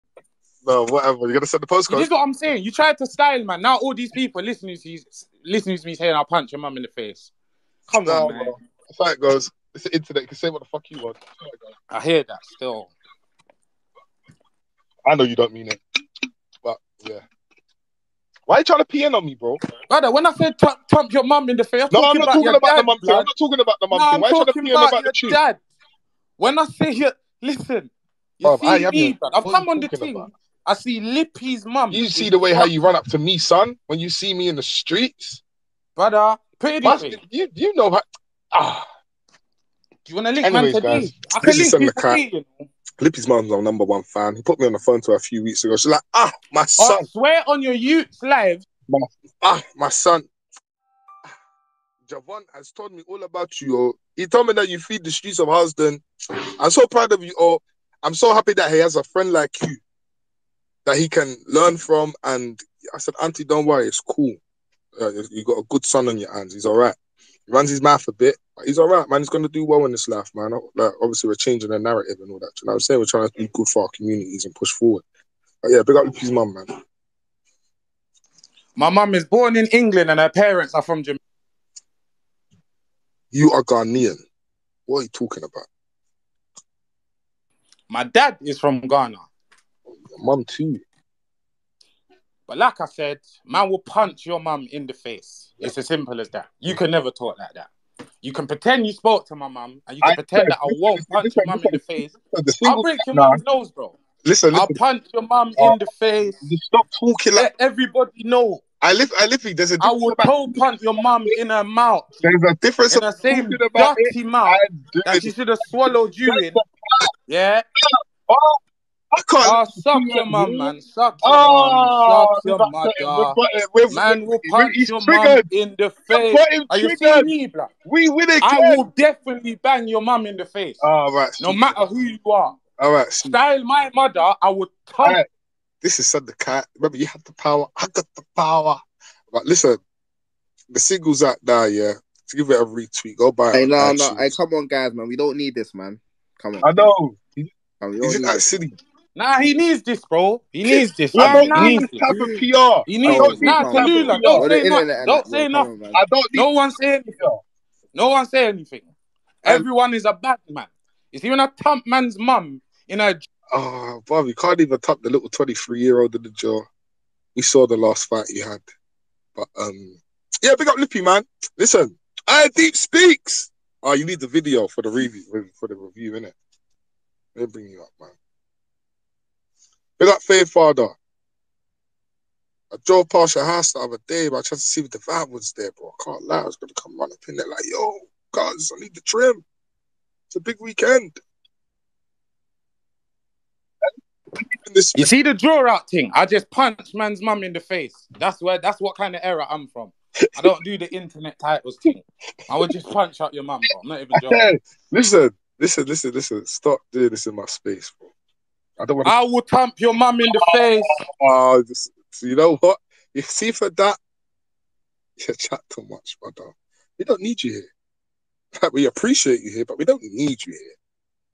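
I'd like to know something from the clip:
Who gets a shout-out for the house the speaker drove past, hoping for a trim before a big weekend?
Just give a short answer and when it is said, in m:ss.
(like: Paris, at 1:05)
Faith Father, at 3:00.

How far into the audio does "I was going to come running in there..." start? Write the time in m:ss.
3:06.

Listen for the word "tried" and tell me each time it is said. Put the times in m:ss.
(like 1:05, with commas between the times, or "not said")
0:02, 3:04.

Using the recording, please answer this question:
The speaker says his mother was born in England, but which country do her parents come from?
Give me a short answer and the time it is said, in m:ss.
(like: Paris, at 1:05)
Jamaica, at 1:21.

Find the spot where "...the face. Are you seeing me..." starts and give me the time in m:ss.
2:05.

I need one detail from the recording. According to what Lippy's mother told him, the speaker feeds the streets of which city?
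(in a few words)
Houston.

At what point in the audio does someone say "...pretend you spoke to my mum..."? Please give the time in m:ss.
1:38.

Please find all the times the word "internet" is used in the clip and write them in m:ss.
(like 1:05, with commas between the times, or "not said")
0:09, 3:20.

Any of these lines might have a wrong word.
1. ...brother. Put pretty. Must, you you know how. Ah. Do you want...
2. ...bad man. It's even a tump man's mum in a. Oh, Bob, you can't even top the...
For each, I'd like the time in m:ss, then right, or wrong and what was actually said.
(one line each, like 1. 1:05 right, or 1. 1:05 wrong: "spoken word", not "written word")
1. 0:35 right
2. 2:40 right.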